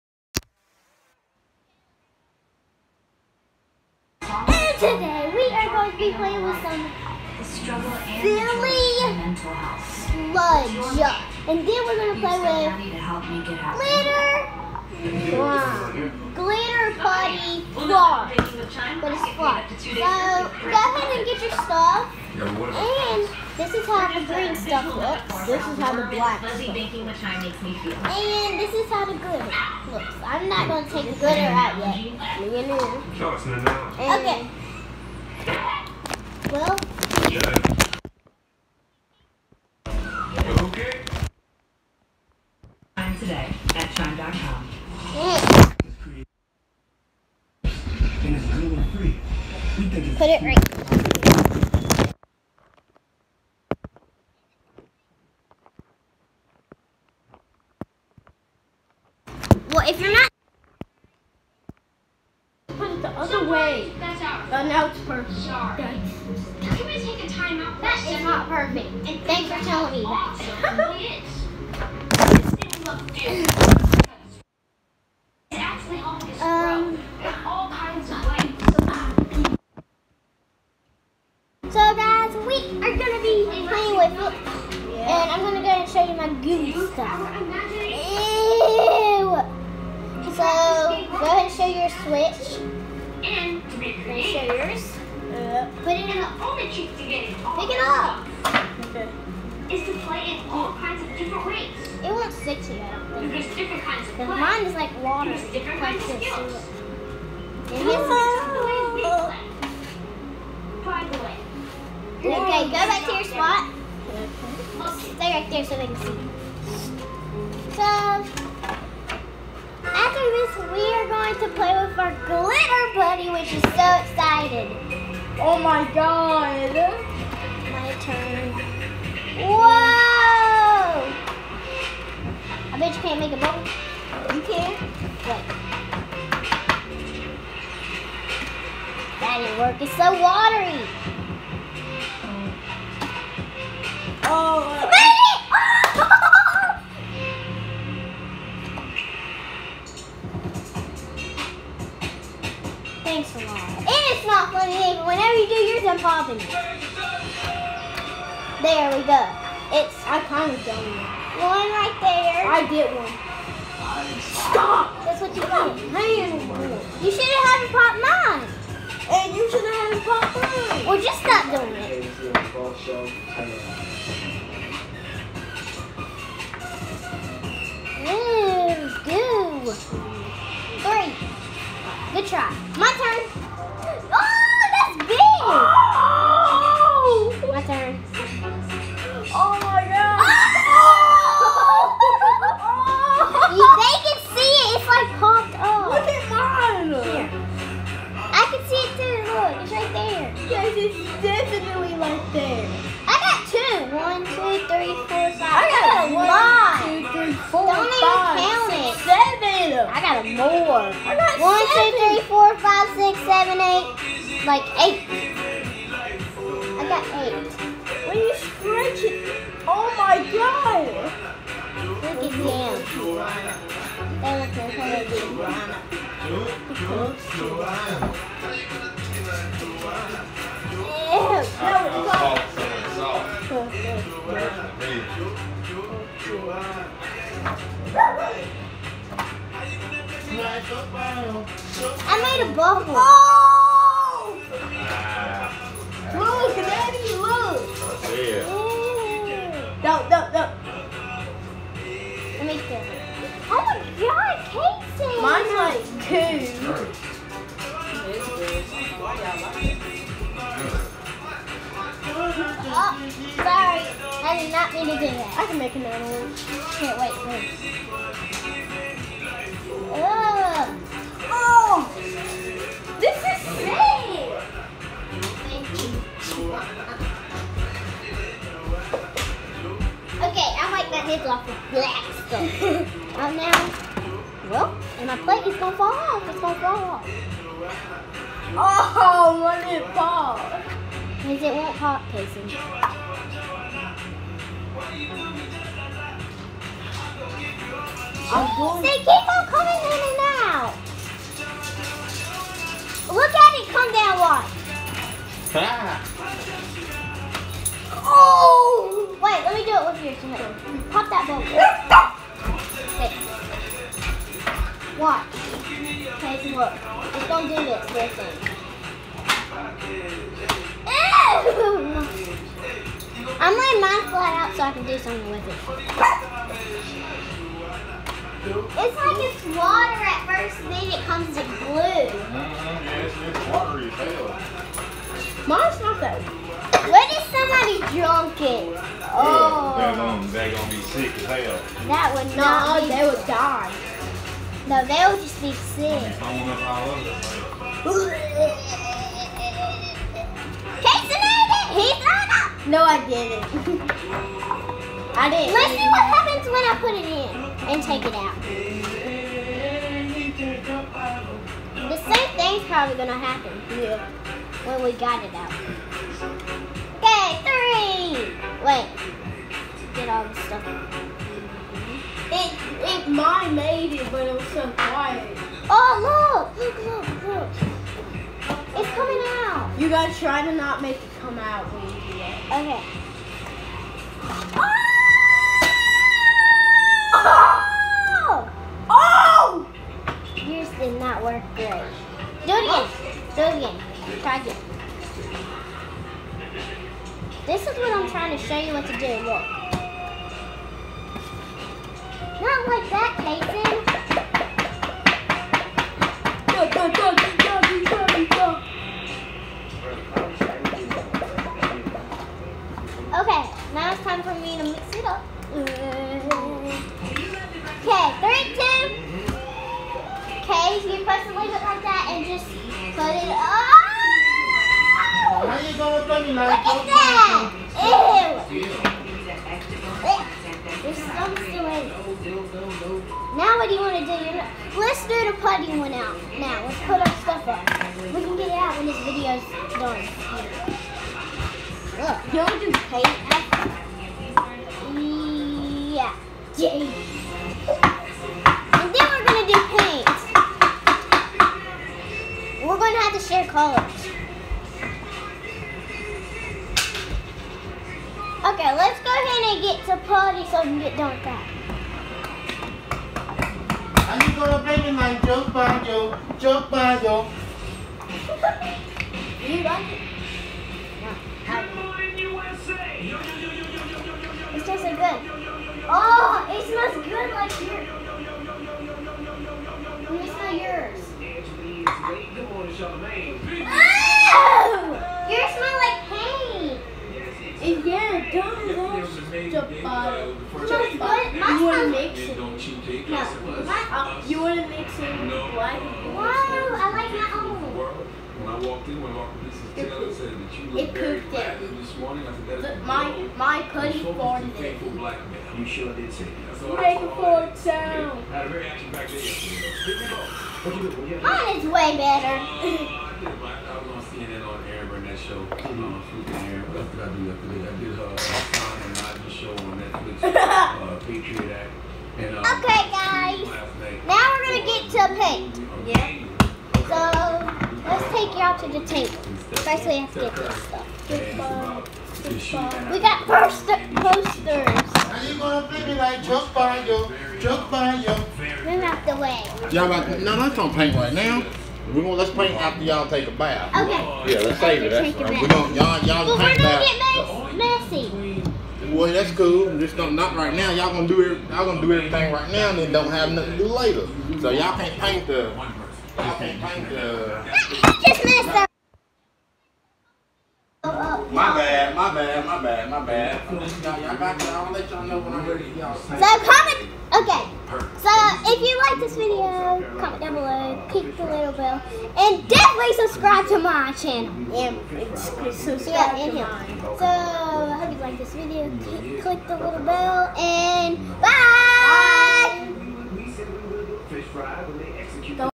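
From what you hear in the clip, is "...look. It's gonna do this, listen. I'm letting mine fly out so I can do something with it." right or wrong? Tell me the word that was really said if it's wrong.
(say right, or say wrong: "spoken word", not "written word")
right.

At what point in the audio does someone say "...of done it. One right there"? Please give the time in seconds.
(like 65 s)
160 s.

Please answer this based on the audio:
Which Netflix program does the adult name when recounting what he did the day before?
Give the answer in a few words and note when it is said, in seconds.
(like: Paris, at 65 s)
Patriot Act, at 521 s.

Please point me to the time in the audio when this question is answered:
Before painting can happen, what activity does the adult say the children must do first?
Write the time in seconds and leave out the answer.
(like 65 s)
543 s.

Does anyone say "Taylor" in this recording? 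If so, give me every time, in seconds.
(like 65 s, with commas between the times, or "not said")
499 s.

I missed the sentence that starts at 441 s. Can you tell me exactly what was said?
Look, you to do paint Yeah.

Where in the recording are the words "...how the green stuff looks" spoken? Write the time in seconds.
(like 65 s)
23 s.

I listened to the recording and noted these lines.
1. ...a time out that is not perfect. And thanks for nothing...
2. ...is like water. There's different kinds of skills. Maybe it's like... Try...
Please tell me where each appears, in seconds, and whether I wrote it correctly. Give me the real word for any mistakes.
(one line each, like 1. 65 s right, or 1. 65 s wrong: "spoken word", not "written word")
1. 67 s wrong: "telling", not "nothing"
2. 104 s right.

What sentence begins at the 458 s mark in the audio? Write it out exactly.
Okay, let's go ahead and get to party so we can get done with that.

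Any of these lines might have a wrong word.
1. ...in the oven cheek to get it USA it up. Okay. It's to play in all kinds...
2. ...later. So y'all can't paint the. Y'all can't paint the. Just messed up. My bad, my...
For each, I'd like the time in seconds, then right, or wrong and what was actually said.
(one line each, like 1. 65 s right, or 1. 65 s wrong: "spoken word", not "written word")
1. 96 s wrong: "Pick", not "USA"
2. 553 s right.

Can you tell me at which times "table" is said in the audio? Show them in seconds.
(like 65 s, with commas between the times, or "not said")
528 s.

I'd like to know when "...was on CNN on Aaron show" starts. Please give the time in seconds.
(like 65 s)
513 s.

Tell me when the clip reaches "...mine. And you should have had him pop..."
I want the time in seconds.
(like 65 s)
167 s.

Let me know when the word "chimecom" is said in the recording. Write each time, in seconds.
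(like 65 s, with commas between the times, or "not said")
43 s.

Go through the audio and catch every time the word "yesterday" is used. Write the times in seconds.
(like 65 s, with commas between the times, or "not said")
509 s, 517 s.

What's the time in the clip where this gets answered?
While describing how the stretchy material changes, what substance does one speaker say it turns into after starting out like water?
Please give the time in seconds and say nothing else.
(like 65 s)
331 s.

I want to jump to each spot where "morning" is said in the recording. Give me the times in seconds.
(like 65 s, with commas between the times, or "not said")
471 s, 501 s.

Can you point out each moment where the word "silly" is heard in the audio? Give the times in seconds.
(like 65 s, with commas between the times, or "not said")
7 s.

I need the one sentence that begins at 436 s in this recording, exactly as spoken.
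Now, let's put our stuff up.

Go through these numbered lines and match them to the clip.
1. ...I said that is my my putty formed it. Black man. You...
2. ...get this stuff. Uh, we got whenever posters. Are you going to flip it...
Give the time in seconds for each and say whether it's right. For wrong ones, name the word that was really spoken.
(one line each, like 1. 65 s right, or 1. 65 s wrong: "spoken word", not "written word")
1. 502 s right
2. 530 s wrong: "poster", not "whenever".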